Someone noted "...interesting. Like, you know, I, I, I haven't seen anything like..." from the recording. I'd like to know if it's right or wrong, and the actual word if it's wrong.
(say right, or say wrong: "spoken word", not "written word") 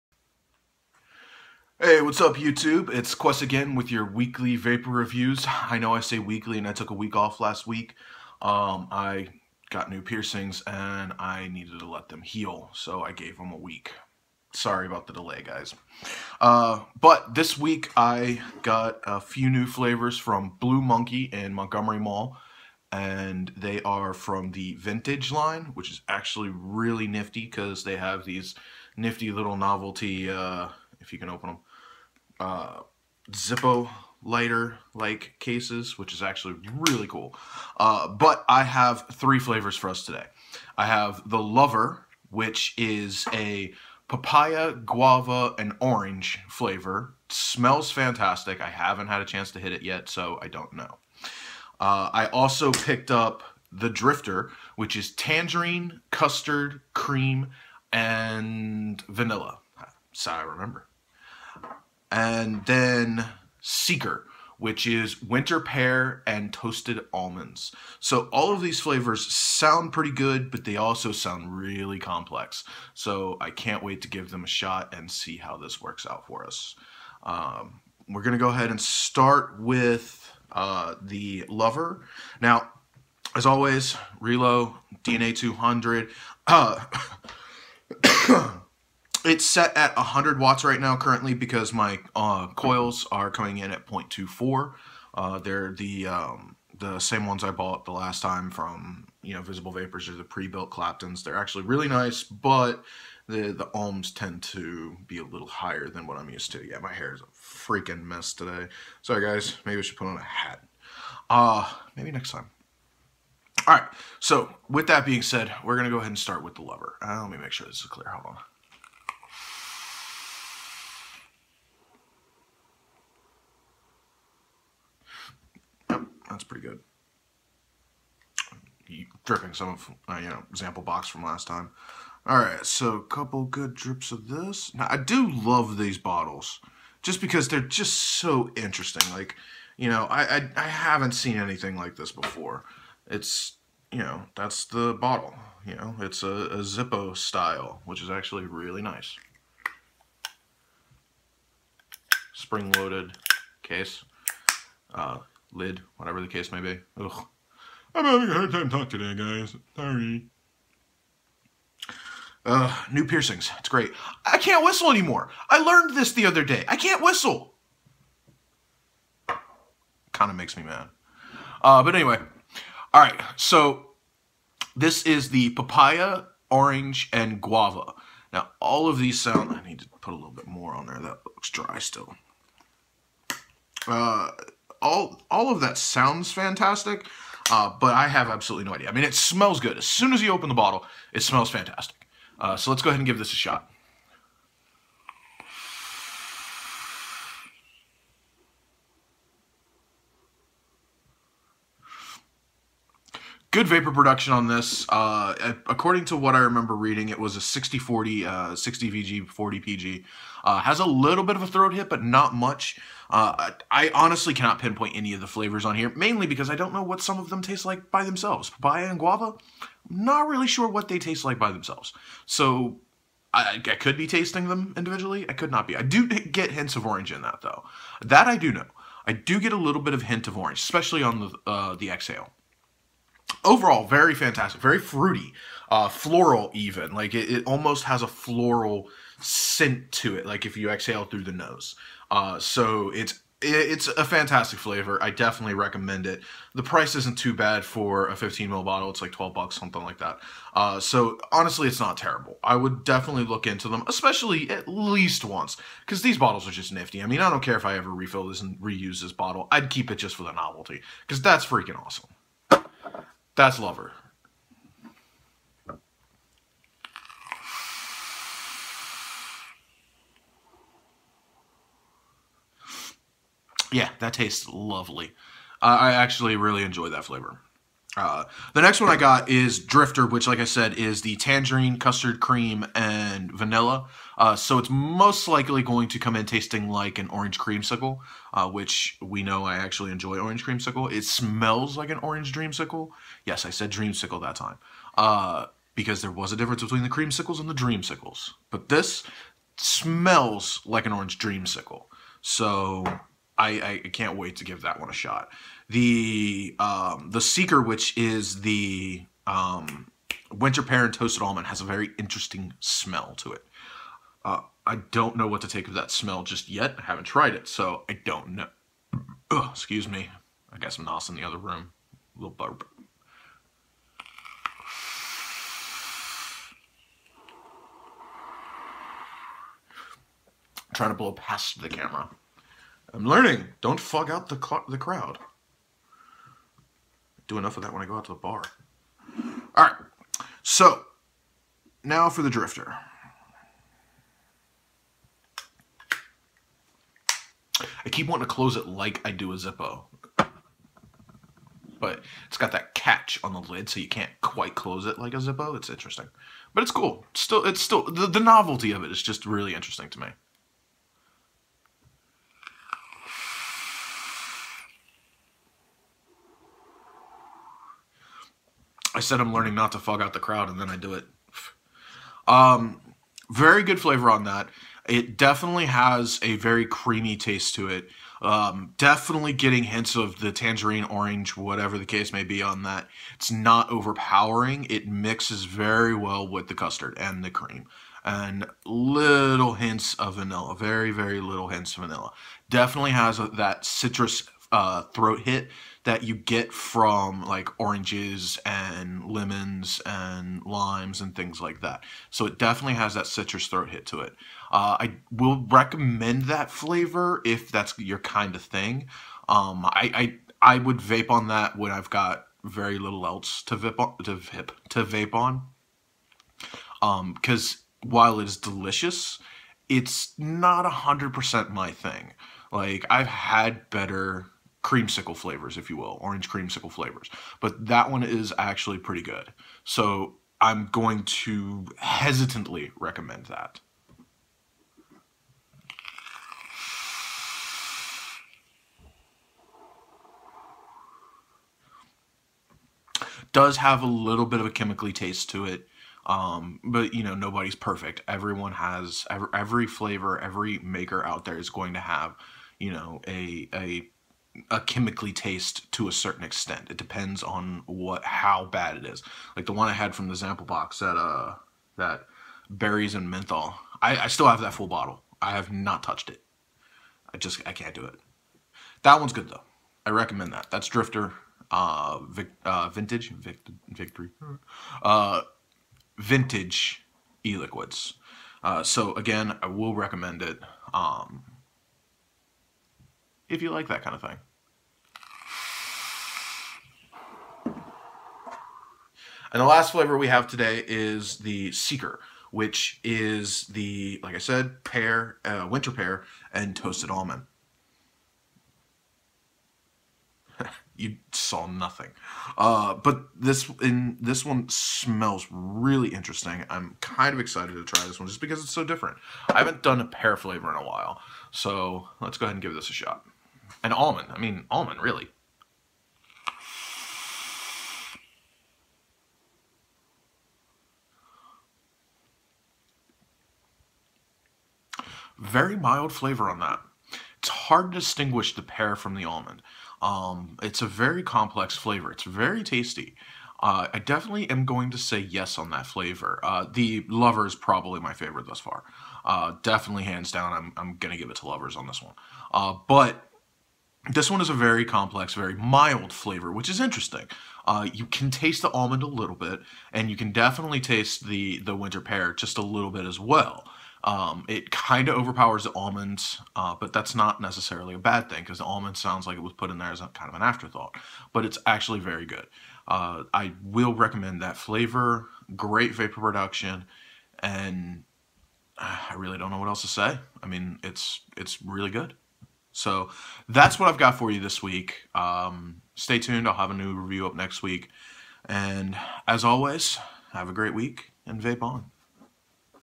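right.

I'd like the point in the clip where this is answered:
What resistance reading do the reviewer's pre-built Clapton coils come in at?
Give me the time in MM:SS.
01:33.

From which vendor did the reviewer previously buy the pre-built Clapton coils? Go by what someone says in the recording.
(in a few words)
Visible Vapors.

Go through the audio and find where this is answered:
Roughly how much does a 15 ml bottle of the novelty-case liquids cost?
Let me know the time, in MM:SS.
04:09.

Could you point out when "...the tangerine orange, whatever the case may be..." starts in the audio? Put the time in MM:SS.
06:20.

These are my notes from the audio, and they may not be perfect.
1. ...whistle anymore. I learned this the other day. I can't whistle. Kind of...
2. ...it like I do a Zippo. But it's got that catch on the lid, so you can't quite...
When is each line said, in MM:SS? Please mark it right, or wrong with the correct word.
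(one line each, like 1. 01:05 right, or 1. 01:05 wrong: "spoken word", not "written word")
1. 02:44 right
2. 05:48 right.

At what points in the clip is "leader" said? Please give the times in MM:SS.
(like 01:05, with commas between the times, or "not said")
not said.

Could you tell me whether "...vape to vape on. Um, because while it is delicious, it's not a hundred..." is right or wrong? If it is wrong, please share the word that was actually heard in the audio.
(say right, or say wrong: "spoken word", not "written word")
right.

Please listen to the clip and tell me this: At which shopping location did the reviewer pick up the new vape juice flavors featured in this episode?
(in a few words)
Montgomery Mall.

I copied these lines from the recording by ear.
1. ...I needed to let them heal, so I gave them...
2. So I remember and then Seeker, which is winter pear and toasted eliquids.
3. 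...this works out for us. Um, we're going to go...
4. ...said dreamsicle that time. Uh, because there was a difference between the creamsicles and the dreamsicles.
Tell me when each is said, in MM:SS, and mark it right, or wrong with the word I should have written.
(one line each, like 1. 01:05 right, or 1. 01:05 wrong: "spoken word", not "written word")
1. 00:11 right
2. 01:00 wrong: "almonds", not "eliquids"
3. 01:15 right
4. 04:53 right.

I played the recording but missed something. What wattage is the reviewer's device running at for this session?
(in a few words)
100 watts.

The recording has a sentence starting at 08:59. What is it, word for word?
Uh, definitely, hands down, I'm, I'm going to give it to Lovers on this one.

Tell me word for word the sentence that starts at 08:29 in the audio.
I haven't done a pear flavor in a while, so let's go ahead and give this a shot.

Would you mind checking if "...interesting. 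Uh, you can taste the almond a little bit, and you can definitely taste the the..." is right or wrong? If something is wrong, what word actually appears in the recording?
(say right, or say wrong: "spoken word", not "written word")
right.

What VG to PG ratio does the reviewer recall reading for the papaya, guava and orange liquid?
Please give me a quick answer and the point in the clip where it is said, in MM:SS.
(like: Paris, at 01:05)
60/40, at 03:28.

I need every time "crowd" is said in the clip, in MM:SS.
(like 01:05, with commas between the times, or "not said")
05:34, 06:10.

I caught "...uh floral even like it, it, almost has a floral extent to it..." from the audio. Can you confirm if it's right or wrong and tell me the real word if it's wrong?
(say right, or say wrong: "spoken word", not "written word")
wrong: "scent", not "extent".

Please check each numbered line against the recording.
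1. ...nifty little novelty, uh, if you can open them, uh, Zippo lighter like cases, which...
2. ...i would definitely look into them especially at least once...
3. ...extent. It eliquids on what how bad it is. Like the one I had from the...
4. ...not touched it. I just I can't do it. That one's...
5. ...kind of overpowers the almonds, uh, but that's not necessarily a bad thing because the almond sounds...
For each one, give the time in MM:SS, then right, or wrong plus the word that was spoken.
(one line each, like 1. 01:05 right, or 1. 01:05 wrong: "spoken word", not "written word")
1. 00:28 right
2. 04:12 right
3. 07:36 wrong: "depends", not "eliquids"
4. 07:45 right
5. 09:14 right.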